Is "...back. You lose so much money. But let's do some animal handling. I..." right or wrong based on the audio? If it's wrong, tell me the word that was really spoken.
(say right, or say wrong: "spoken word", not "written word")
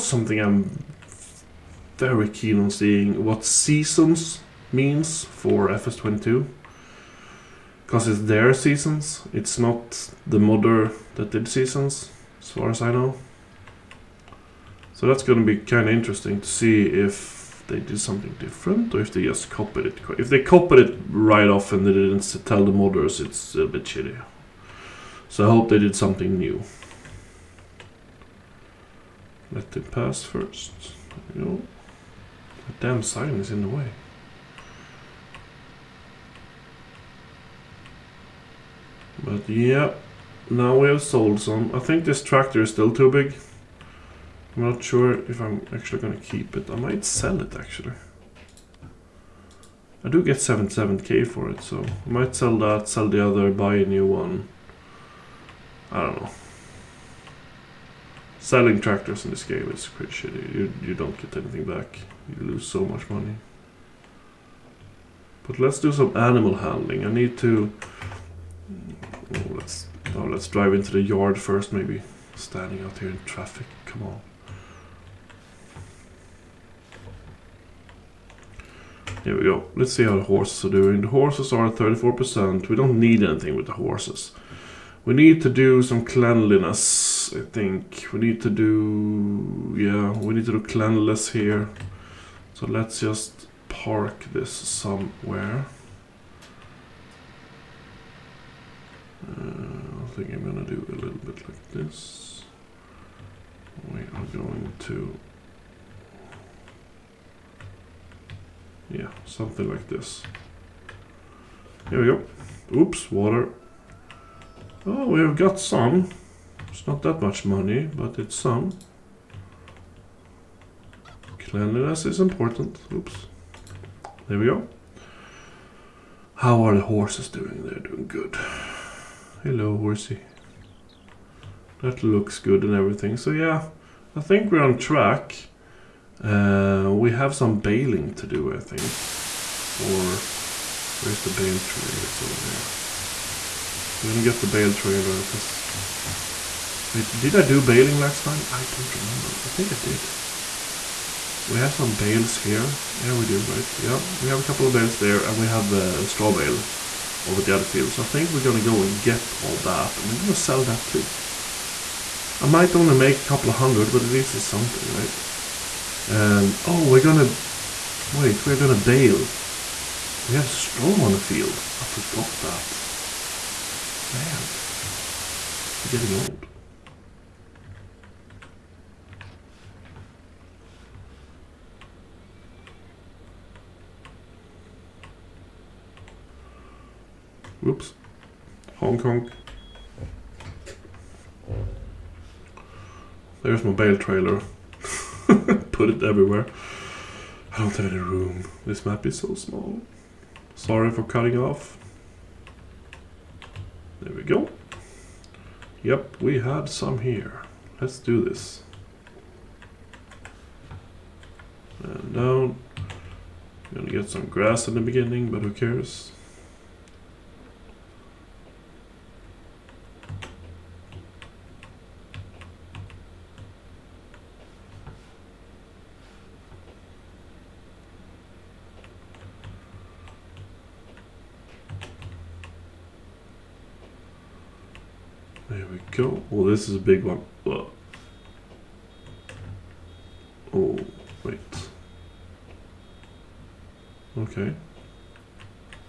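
right.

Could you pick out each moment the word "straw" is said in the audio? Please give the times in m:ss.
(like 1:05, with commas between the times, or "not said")
2:36, 2:50.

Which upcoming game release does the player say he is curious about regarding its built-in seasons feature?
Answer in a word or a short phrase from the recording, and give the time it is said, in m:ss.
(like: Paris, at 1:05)
FS22, at 0:05.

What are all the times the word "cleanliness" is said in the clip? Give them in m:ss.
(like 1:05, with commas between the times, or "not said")
1:26, 1:30, 2:01.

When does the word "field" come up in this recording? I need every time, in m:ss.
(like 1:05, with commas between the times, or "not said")
2:37, 2:51.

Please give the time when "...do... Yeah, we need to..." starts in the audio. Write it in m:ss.
1:28.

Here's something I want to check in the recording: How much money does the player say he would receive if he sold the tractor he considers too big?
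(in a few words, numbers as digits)
77k.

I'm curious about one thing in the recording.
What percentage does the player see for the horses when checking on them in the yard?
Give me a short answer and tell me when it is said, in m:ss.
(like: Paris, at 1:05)
34%, at 1:21.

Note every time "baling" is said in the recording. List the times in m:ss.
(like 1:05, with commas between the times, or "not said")
2:17, 2:27.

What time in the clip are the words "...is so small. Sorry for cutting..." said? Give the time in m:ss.
3:19.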